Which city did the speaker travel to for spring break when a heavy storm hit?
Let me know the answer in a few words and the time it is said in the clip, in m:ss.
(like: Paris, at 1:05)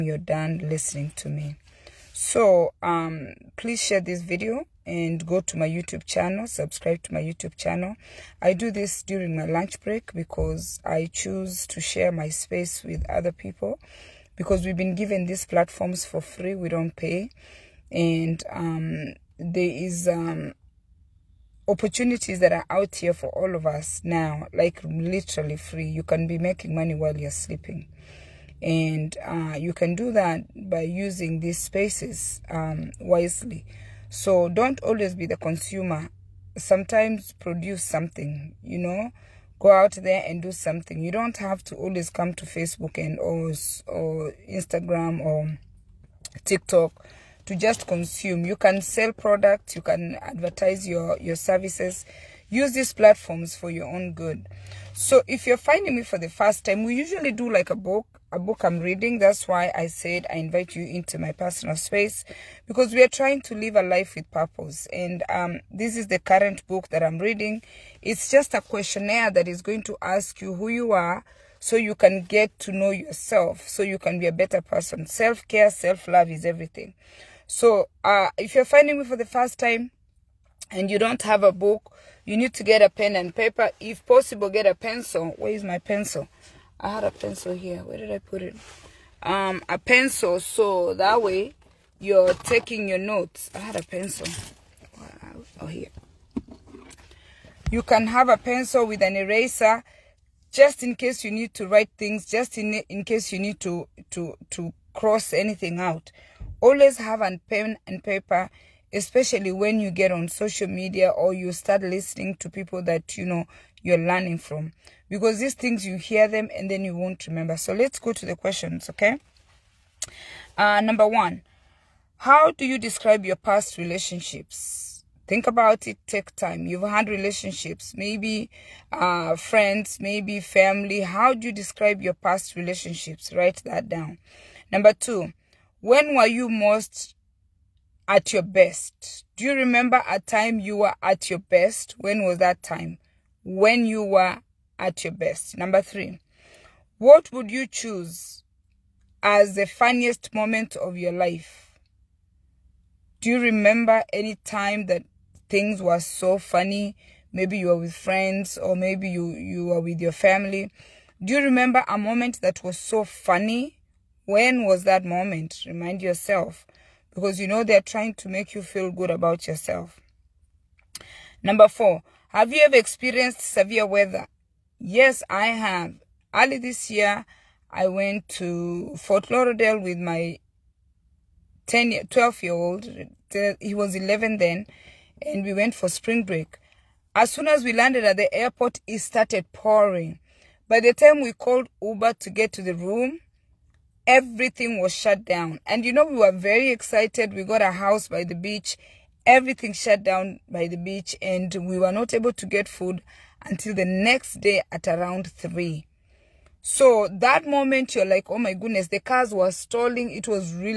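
Fort Lauderdale, at 2:58.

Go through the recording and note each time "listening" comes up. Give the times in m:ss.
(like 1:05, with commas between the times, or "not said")
0:00, 1:51.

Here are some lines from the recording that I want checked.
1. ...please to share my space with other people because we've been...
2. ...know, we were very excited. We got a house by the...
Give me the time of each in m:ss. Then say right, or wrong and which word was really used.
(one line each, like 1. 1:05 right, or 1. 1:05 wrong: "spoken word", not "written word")
1. 0:11 wrong: "choose", not "please"
2. 3:15 right.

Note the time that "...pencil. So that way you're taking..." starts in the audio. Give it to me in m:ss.
1:29.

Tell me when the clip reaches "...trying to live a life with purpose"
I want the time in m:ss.
1:03.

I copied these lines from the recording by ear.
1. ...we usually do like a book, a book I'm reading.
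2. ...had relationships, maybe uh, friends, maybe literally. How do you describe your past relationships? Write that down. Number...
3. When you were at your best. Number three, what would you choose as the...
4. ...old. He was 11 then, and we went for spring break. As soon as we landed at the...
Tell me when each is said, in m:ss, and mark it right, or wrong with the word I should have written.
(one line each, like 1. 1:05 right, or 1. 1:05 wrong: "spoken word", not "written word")
1. 0:56 right
2. 2:06 wrong: "family", not "literally"
3. 2:23 right
4. 3:02 right.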